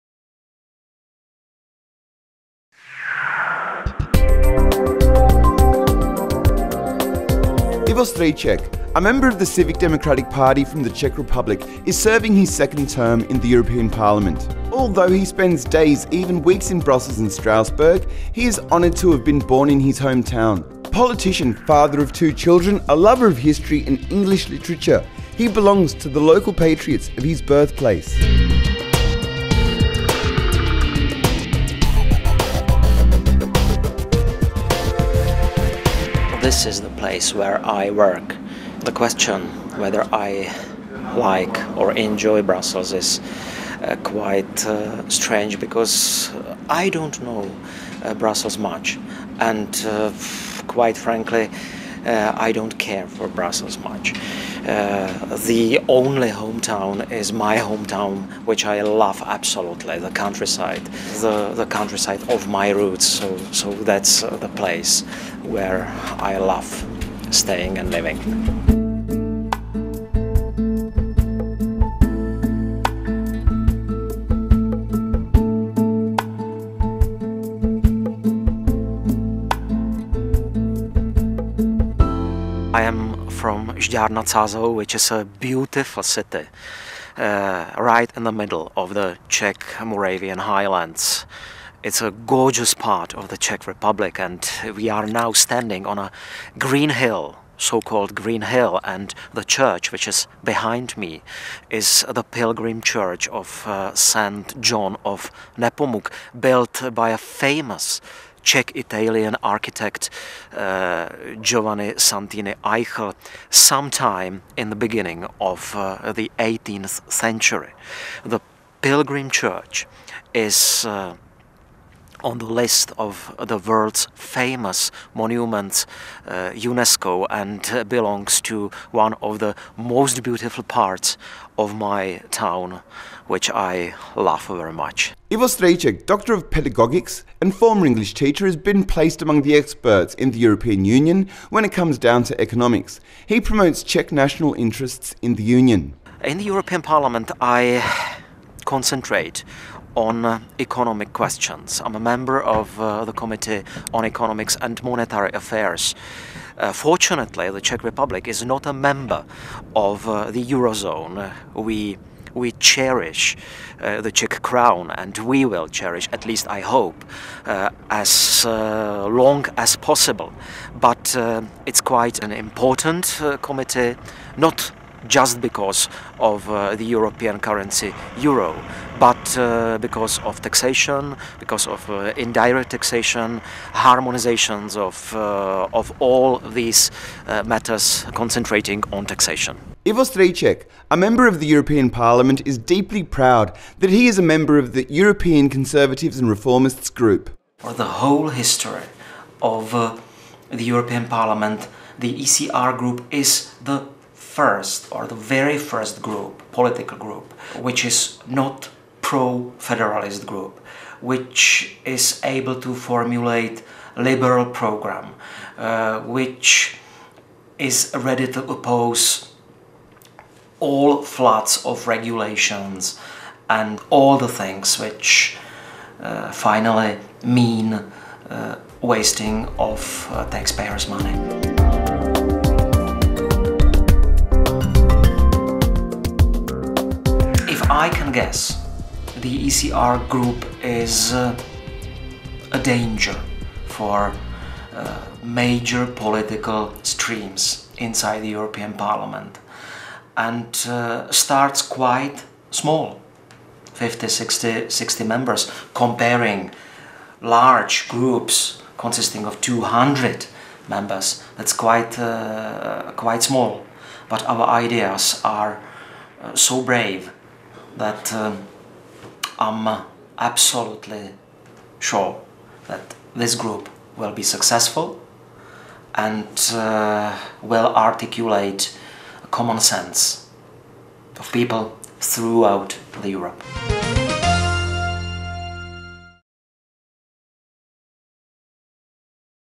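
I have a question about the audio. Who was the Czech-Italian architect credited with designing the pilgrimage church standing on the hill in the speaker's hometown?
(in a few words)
Giovanni Santini Aichel.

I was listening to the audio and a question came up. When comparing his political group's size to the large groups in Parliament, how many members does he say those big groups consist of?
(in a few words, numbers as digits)
200.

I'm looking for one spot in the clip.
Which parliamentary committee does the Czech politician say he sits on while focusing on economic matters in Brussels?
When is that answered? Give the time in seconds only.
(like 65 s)
153 s.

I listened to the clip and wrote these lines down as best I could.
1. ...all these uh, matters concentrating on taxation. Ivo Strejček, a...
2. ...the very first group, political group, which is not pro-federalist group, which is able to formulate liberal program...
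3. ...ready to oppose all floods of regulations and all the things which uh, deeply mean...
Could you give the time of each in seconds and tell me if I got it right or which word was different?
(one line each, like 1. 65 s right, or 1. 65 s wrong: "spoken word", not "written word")
1. 185 s right
2. 205 s right
3. 217 s wrong: "finally", not "deeply".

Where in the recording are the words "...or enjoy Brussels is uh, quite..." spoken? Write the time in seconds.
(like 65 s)
41 s.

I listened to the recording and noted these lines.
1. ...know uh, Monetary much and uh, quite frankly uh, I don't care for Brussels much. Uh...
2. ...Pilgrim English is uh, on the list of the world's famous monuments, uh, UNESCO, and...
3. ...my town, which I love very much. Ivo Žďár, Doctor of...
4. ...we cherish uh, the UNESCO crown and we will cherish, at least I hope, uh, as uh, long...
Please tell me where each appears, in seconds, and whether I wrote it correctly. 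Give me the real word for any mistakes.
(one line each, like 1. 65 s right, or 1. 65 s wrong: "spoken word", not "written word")
1. 47 s wrong: "Brussels", not "Monetary"
2. 118 s wrong: "Church", not "English"
3. 131 s wrong: "Strejček", not "Žďár"
4. 162 s wrong: "Czech", not "UNESCO".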